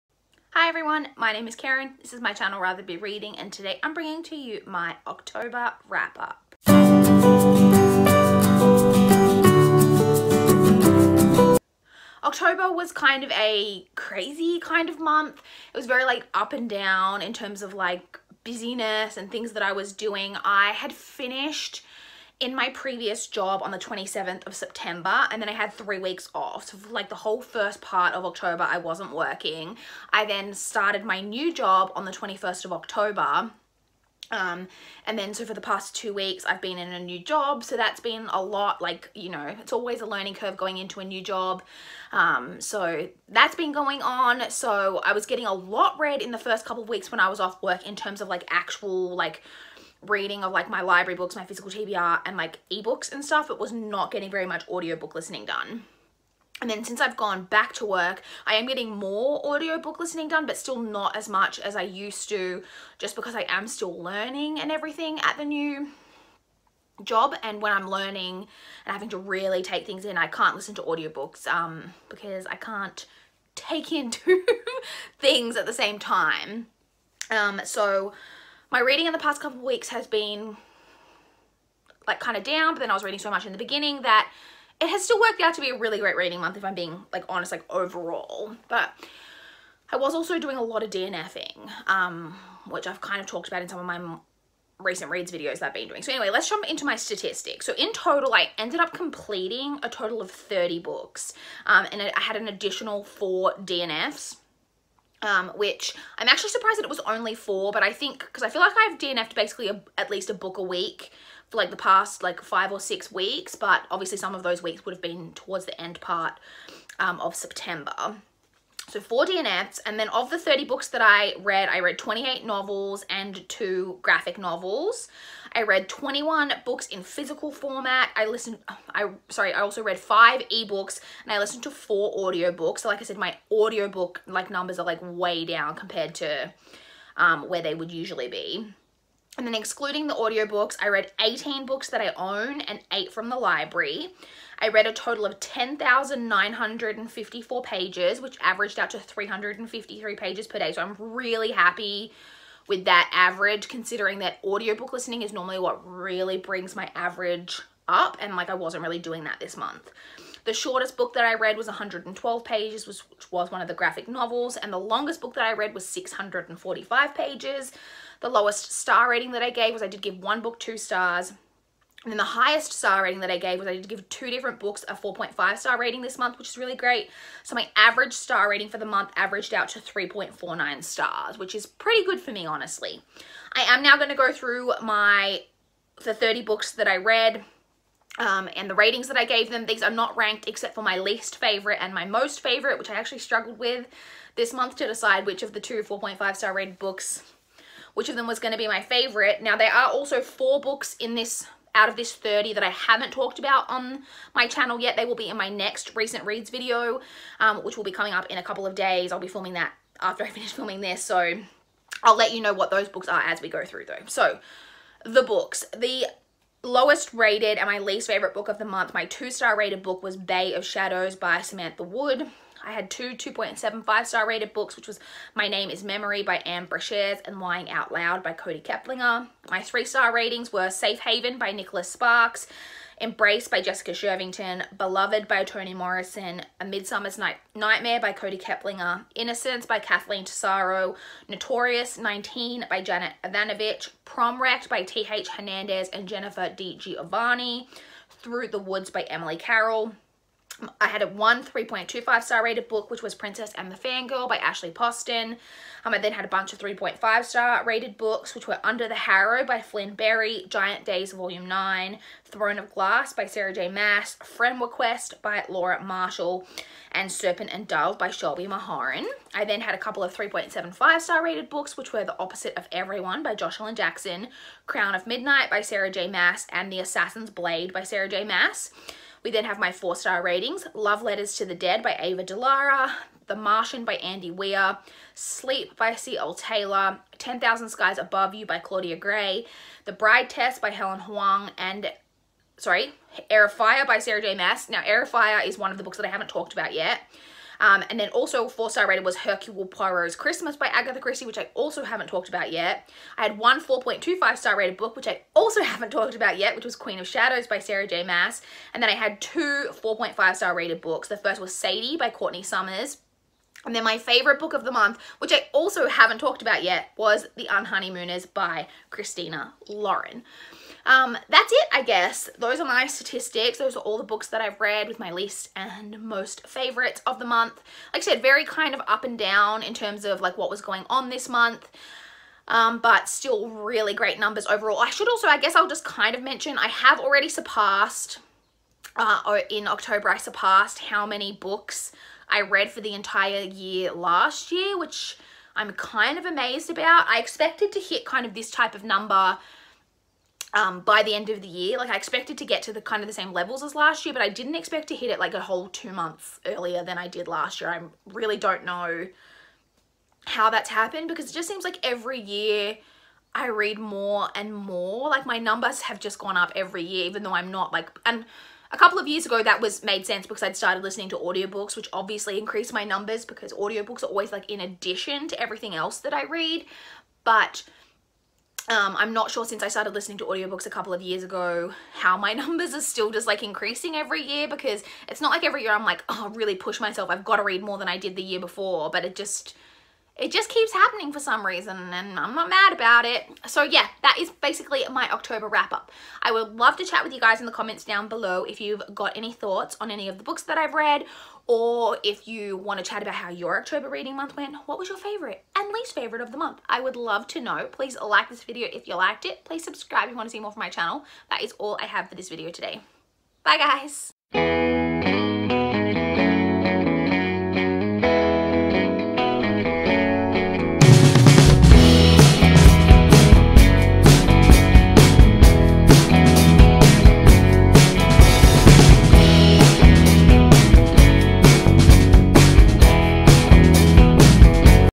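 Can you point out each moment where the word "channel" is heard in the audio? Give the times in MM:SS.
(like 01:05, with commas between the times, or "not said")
00:02, 03:24, 06:50.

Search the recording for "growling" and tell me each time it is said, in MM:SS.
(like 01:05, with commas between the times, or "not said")
not said.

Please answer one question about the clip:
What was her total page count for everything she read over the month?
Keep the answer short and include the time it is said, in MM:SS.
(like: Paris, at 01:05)
10,954, at 02:25.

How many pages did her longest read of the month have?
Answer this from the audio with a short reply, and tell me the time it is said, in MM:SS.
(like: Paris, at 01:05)
645, at 02:45.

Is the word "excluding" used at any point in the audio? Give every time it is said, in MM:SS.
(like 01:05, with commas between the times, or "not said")
02:19.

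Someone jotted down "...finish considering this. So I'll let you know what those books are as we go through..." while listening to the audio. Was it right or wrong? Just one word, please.
wrong.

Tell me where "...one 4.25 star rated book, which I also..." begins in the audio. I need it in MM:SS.
05:03.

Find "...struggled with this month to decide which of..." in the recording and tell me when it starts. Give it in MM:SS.
03:13.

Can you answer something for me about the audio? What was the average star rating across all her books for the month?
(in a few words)
3.49.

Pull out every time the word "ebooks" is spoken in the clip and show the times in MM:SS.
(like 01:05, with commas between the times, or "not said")
00:52, 02:10.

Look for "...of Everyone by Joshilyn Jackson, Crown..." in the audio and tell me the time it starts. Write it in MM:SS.
04:32.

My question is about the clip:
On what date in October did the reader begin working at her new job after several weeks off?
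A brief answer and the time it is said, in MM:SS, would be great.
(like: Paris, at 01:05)
21st of October, at 00:32.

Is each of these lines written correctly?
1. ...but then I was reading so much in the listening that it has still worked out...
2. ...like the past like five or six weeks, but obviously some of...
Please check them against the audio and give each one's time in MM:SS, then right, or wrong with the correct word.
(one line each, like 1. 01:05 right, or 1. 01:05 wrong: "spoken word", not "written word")
1. 01:22 wrong: "beginning", not "listening"
2. 01:51 right.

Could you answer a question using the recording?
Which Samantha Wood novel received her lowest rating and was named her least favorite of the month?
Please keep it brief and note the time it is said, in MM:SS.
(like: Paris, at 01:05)
Bay of Shadows, at 03:40.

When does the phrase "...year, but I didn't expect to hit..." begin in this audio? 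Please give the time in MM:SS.
05:54.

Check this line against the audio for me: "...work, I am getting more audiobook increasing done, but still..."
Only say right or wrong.
wrong.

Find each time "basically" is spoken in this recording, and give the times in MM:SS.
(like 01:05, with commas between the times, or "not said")
01:49, 06:34.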